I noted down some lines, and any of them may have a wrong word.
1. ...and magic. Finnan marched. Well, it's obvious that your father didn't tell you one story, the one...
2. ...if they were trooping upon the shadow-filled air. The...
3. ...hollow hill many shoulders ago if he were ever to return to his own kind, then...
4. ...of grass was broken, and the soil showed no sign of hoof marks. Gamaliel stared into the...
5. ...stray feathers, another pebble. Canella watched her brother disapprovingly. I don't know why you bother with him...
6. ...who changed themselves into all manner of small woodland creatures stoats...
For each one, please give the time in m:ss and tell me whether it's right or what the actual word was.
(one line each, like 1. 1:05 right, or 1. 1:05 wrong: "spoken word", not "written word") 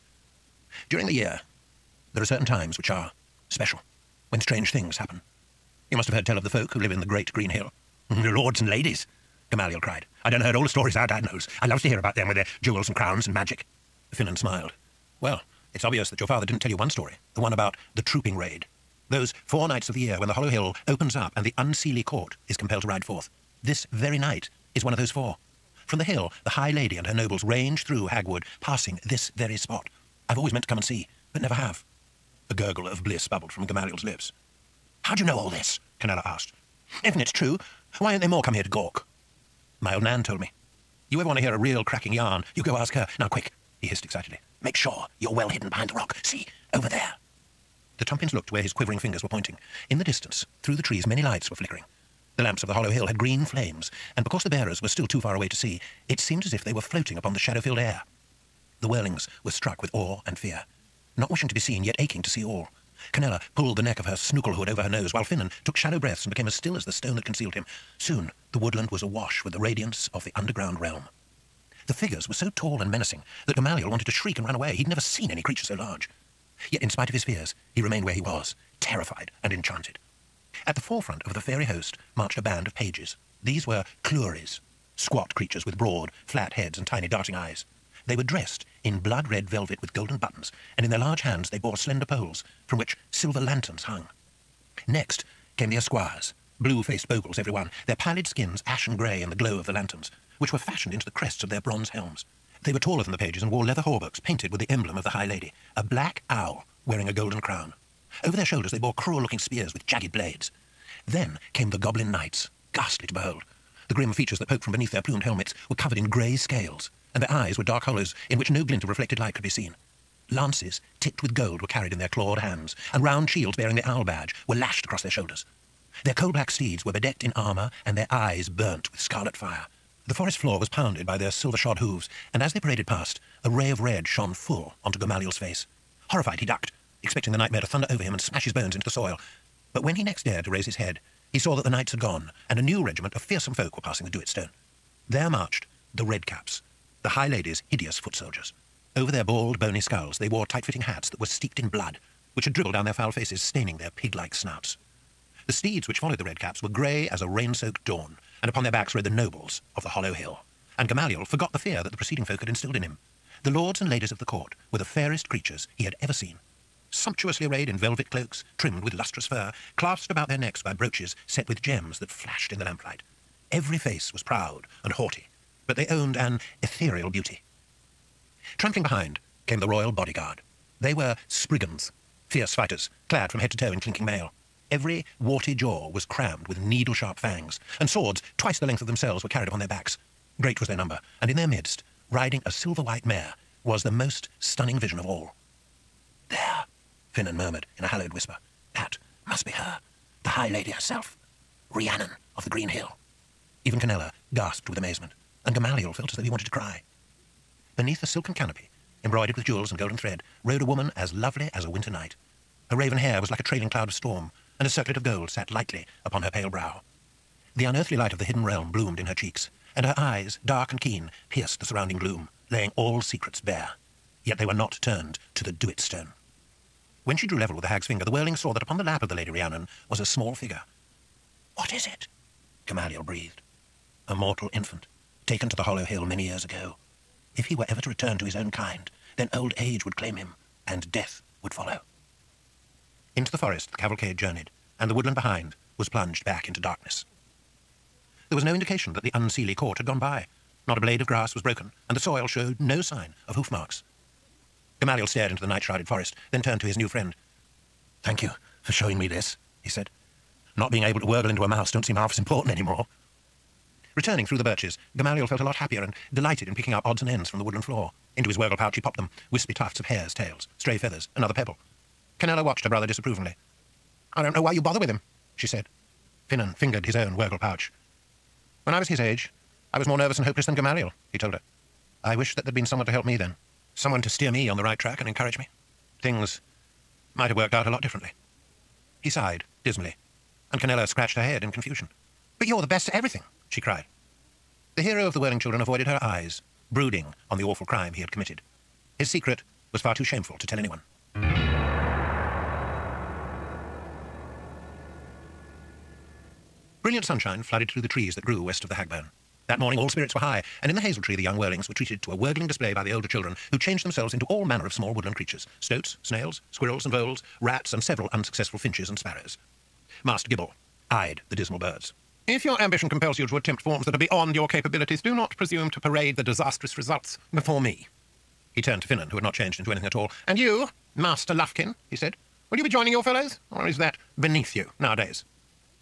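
1. 0:13 wrong: "smiled", not "marched"
2. 0:56 wrong: "floating", not "trooping"
3. 3:55 wrong: "years", not "shoulders"
4. 4:11 right
5. 4:30 right
6. 5:13 right.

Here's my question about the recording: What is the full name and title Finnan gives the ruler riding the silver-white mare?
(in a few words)
Rhiannon of the Green Hill.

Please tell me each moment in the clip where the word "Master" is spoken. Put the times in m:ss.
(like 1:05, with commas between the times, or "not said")
5:20, 5:30.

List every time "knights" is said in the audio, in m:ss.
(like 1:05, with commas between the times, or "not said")
1:52, 2:21.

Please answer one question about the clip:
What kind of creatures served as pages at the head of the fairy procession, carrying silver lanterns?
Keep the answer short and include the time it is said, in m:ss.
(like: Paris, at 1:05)
Clurys, at 1:24.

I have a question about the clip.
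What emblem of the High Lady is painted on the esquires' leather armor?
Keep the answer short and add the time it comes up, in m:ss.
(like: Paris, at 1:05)
A black owl wearing a golden crown, at 1:45.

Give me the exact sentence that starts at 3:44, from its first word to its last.
Yet they were not turned to the do-it stone.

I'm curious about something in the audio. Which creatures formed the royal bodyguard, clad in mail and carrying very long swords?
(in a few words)
Spriggans.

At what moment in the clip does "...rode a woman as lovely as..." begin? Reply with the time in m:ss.
3:30.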